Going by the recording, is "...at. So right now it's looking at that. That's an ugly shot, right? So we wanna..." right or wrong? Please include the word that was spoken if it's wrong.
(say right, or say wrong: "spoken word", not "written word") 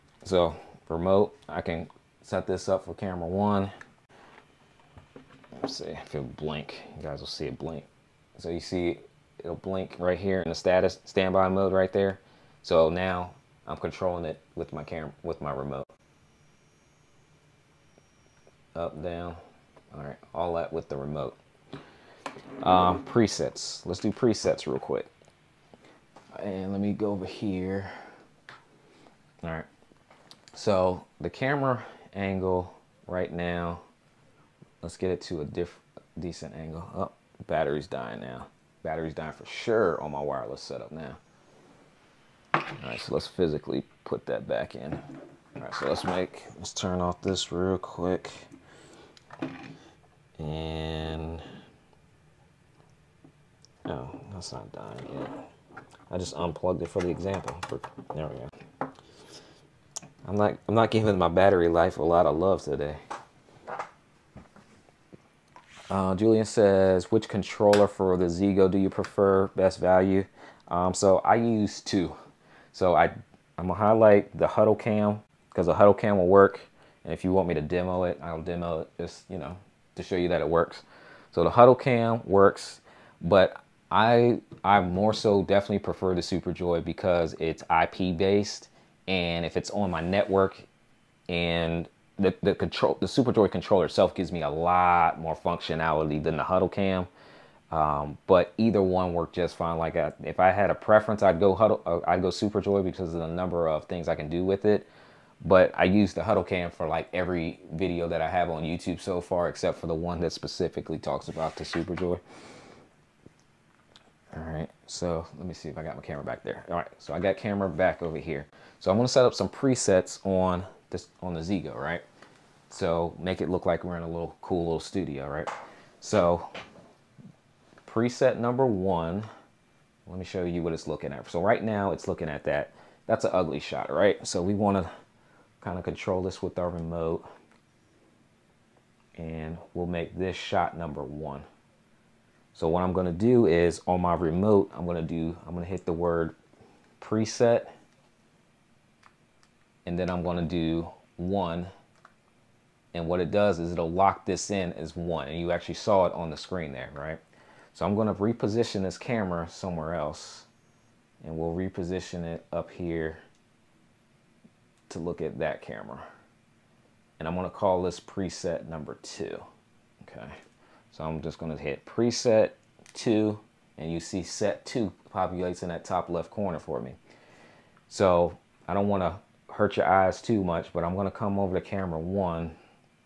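right.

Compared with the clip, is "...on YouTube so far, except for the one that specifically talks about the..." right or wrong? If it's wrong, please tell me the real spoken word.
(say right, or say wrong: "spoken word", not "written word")
right.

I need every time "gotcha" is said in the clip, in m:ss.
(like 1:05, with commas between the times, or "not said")
not said.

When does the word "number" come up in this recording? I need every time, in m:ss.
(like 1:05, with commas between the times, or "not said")
1:43, 2:08, 2:20, 2:48.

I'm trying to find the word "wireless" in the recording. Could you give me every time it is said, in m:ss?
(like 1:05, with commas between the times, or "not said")
0:40.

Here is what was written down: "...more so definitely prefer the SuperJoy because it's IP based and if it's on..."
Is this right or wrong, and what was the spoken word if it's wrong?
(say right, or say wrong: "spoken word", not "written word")
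right.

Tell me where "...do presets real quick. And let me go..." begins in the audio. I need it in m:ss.
0:24.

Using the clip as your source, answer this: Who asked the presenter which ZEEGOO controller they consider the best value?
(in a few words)
Julian.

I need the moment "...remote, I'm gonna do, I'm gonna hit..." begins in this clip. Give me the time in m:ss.
2:24.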